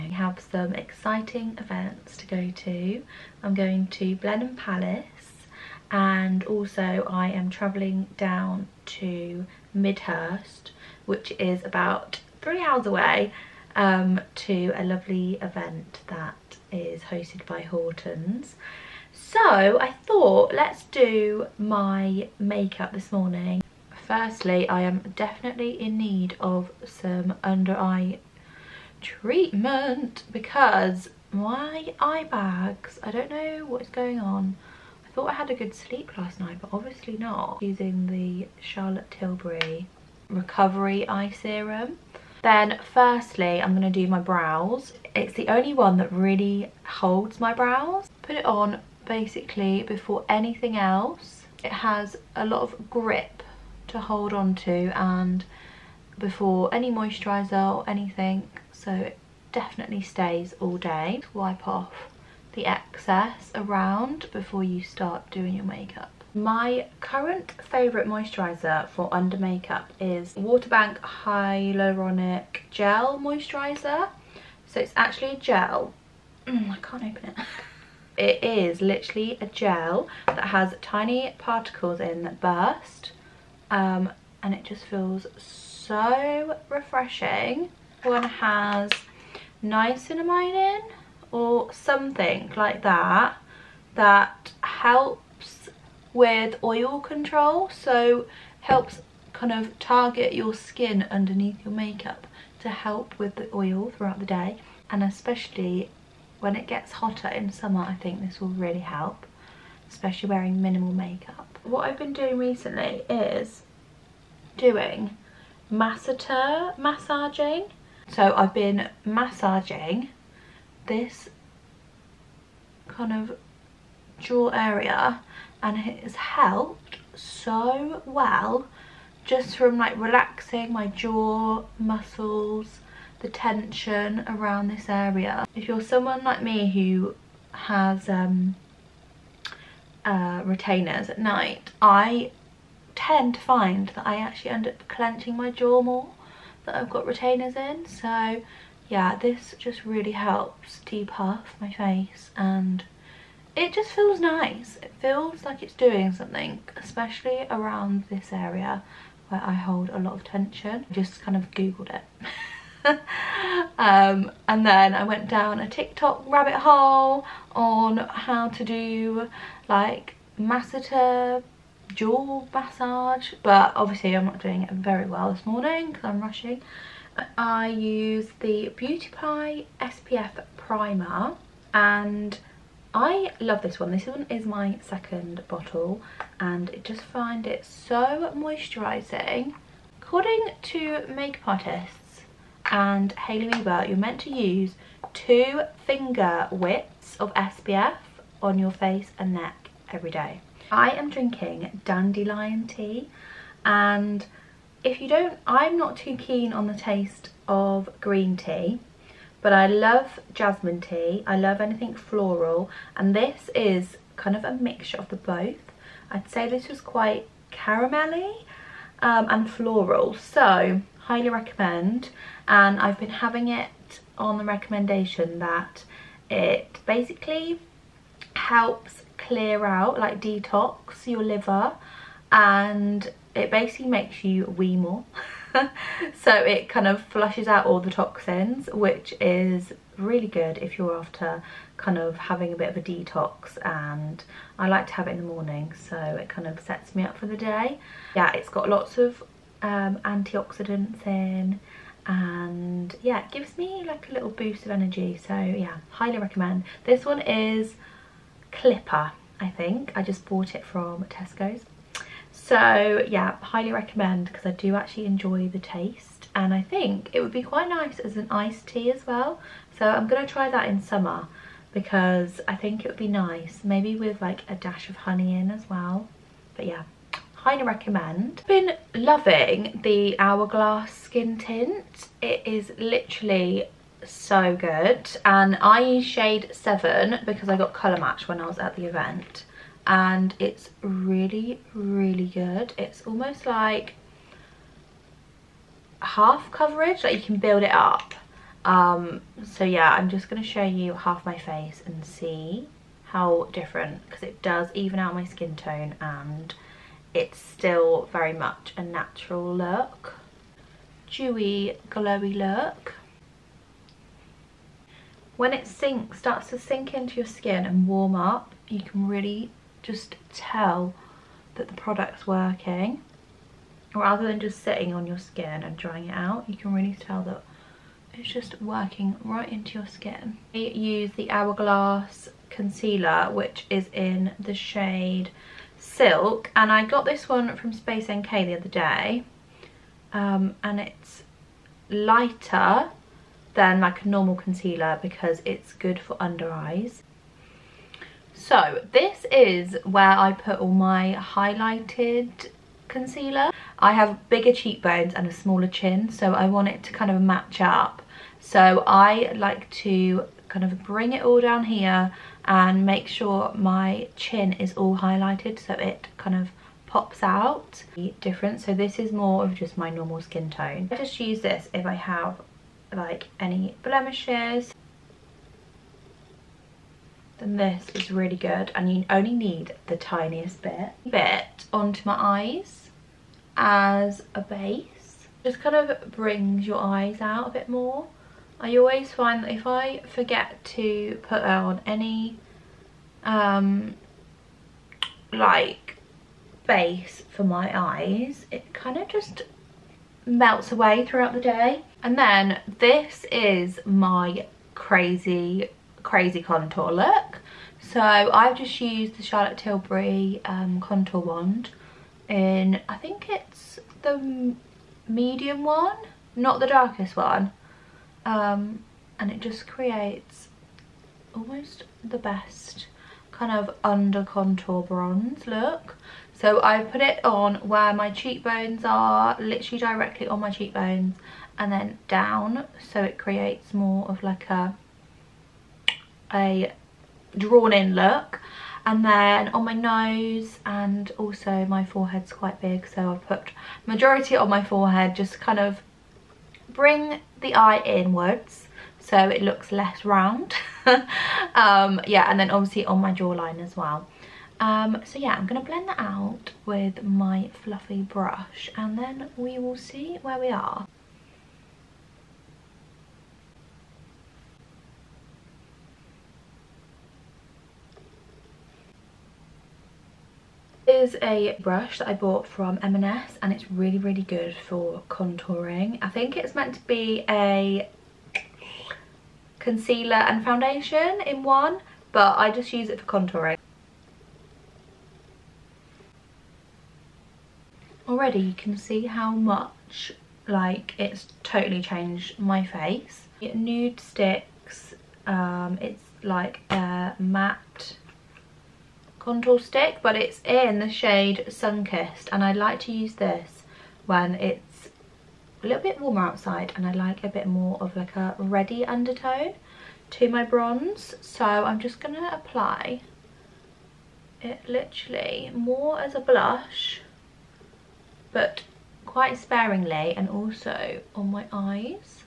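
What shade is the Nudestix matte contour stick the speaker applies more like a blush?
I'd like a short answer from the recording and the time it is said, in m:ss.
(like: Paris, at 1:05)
Sunkissed, at 8:21.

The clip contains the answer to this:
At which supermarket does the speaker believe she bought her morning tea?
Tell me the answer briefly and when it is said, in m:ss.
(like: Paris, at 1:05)
Tesco, at 4:21.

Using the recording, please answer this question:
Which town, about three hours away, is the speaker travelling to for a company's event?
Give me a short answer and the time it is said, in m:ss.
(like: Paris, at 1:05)
Midhurst, at 0:09.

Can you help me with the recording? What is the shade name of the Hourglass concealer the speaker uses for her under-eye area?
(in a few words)
Silk.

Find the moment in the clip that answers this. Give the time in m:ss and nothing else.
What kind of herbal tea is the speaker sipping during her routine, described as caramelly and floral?
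3:21.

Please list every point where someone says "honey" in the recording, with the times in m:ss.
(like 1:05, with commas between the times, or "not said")
4:34.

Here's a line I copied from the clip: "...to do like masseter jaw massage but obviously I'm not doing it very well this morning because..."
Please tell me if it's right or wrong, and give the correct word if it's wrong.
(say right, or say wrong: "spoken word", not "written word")
right.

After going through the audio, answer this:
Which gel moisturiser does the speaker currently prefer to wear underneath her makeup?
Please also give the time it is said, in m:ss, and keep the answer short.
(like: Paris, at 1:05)
Waterbank Hyaluronic Gel Moisturiser, at 1:10.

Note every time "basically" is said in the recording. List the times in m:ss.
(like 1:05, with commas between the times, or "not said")
0:49, 3:46, 3:53.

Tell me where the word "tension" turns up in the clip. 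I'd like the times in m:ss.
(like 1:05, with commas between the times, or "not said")
2:13, 2:40.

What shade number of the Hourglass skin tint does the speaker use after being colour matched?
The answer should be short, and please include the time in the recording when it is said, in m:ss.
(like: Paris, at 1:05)
7, at 4:46.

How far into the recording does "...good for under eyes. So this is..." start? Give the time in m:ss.
5:45.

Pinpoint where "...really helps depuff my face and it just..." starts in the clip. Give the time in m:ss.
2:29.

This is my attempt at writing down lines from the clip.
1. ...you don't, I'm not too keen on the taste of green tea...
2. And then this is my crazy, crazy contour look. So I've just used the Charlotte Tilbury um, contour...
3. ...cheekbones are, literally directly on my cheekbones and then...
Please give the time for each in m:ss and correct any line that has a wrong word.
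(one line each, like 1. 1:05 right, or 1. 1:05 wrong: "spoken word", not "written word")
1. 3:25 right
2. 6:42 right
3. 7:08 right.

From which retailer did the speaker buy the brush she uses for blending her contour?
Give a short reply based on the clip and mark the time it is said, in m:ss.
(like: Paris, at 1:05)
M&S, at 7:52.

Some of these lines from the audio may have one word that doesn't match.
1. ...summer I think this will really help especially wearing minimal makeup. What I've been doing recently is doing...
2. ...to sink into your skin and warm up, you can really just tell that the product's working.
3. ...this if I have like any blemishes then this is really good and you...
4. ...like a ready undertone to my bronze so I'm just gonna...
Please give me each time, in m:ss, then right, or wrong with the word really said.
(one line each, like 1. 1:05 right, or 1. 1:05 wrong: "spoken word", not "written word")
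1. 1:47 right
2. 5:16 right
3. 6:11 right
4. 8:27 right.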